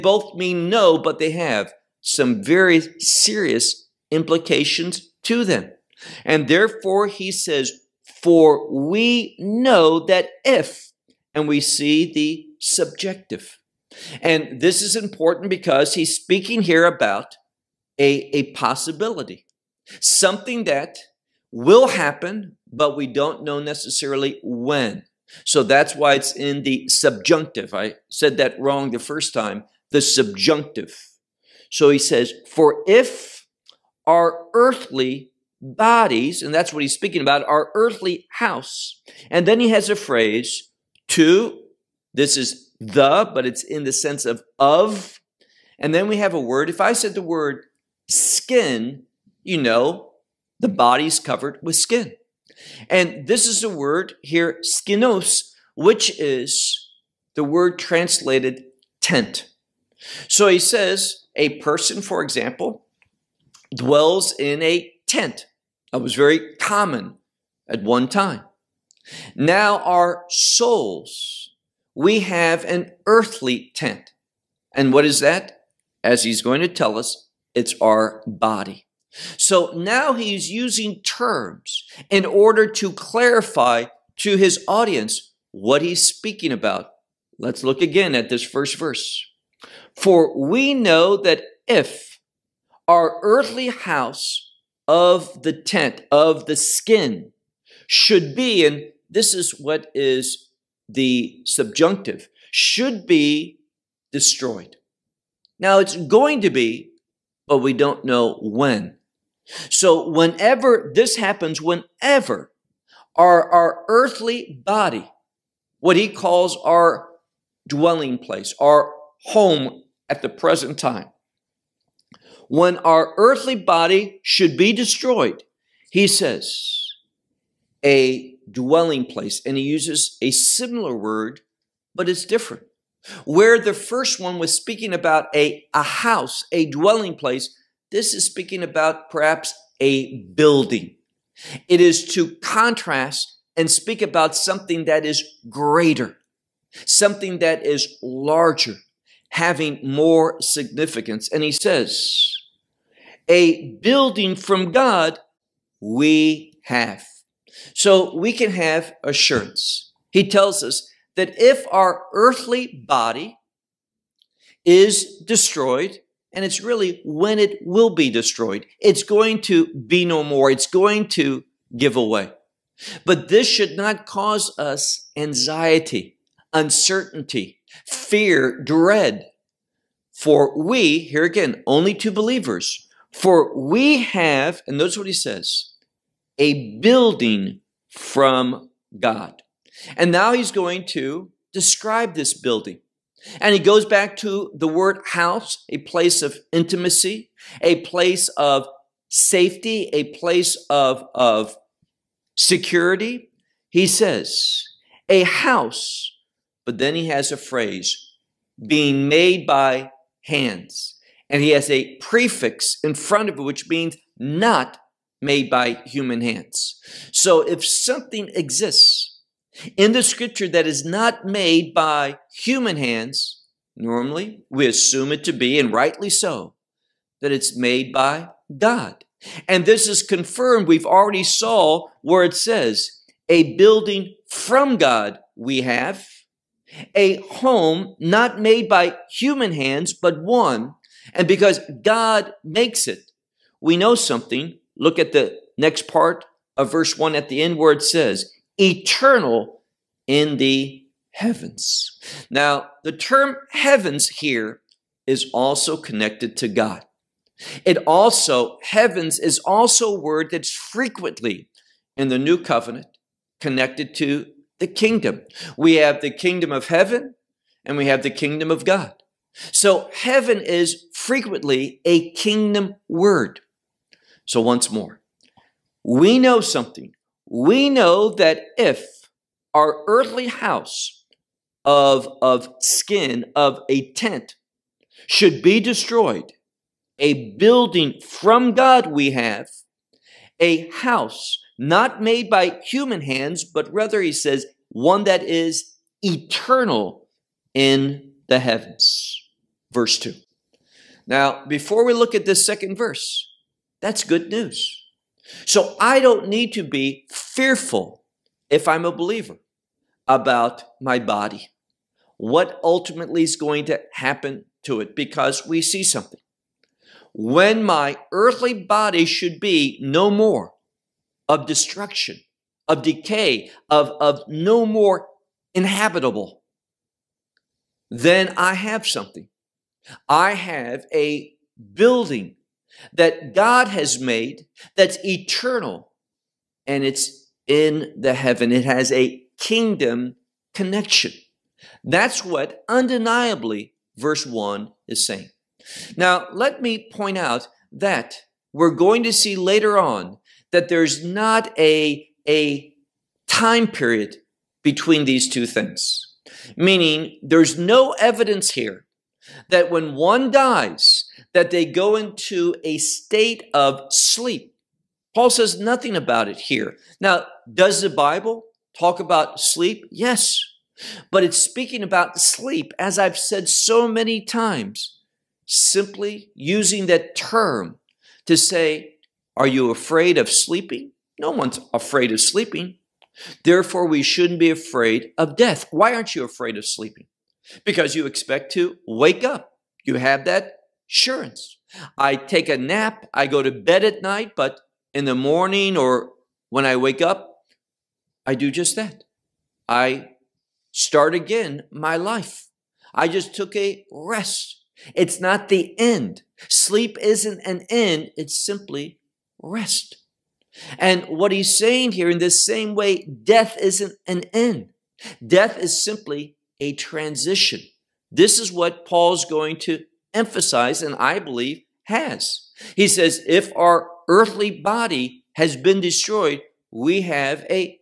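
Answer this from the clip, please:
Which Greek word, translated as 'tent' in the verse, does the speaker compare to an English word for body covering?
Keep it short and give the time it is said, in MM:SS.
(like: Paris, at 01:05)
skinos, at 00:54.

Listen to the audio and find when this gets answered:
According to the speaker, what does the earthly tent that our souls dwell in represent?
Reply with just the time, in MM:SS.
01:17.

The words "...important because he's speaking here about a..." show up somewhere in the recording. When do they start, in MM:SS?
00:14.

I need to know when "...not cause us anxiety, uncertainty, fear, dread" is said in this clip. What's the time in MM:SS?
02:53.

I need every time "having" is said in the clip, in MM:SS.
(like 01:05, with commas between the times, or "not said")
02:29.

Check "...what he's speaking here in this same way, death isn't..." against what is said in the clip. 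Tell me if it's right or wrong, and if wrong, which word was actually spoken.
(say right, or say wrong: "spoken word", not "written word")
wrong: "saying", not "speaking".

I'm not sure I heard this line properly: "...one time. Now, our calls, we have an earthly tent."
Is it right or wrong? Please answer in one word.
wrong.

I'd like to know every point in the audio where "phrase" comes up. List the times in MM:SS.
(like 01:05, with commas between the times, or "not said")
00:39, 03:27.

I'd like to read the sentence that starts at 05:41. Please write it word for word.
That's what undeniably verse 1 is saying.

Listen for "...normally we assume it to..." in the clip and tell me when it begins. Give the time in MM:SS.
03:43.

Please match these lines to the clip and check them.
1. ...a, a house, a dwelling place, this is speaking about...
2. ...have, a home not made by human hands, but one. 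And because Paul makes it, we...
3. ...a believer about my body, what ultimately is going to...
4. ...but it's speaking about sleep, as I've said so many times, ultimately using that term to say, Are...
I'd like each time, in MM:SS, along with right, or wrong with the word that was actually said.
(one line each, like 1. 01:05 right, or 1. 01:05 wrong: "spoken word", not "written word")
1. 02:15 right
2. 03:55 wrong: "God", not "Paul"
3. 05:08 right
4. 06:11 wrong: "simply", not "ultimately".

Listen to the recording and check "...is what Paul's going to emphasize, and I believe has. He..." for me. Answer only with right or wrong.
right.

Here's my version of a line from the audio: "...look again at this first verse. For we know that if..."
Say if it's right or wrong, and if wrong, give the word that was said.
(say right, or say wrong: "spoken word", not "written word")
right.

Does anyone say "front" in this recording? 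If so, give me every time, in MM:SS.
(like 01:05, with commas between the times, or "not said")
03:32.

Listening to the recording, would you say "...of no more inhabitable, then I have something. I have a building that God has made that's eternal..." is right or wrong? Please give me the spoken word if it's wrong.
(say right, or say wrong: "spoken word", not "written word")
right.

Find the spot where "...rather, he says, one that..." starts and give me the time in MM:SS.
04:53.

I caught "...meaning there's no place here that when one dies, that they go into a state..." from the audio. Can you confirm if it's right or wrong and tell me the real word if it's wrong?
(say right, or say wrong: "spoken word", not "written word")
wrong: "evidence", not "place".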